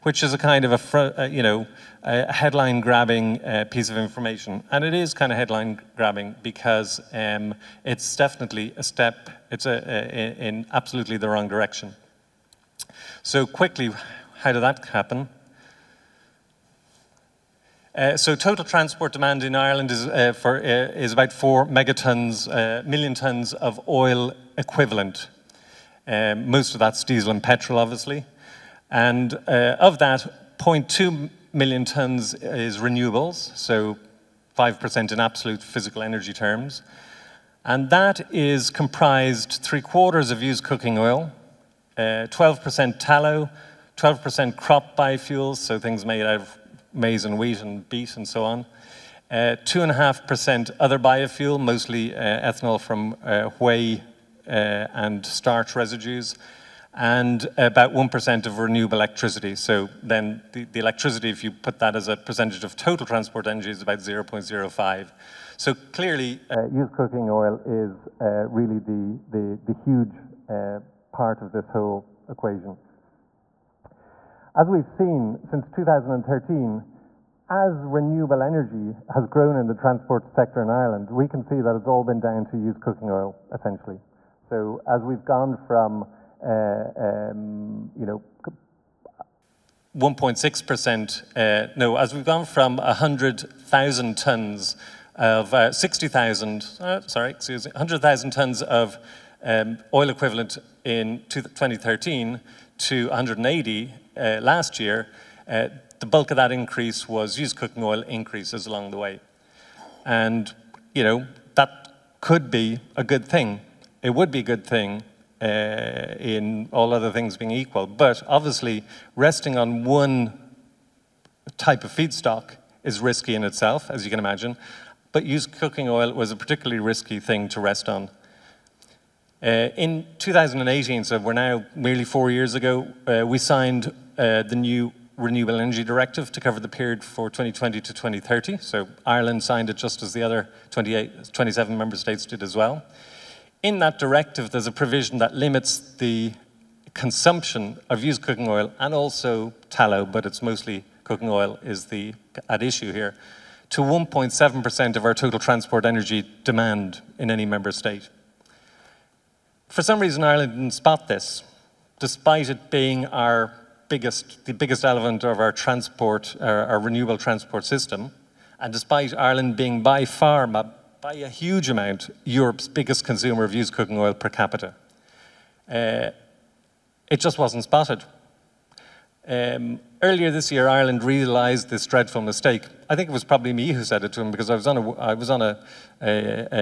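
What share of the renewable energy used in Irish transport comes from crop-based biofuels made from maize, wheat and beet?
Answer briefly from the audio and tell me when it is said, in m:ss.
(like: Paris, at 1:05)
12%, at 0:43.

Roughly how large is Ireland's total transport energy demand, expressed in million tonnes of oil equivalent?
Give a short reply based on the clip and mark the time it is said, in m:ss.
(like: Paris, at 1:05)
4, at 0:21.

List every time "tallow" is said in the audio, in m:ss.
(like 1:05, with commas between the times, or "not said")
0:42, 2:29.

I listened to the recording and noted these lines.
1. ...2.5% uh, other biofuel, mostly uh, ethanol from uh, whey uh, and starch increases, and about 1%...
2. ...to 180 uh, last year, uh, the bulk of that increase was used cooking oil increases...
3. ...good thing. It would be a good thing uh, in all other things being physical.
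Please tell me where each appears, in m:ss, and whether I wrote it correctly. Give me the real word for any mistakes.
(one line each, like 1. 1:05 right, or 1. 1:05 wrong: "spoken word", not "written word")
1. 0:49 wrong: "residues", not "increases"
2. 1:42 right
3. 1:53 wrong: "equal", not "physical".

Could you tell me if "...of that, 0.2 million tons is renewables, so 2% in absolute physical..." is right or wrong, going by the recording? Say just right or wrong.
wrong.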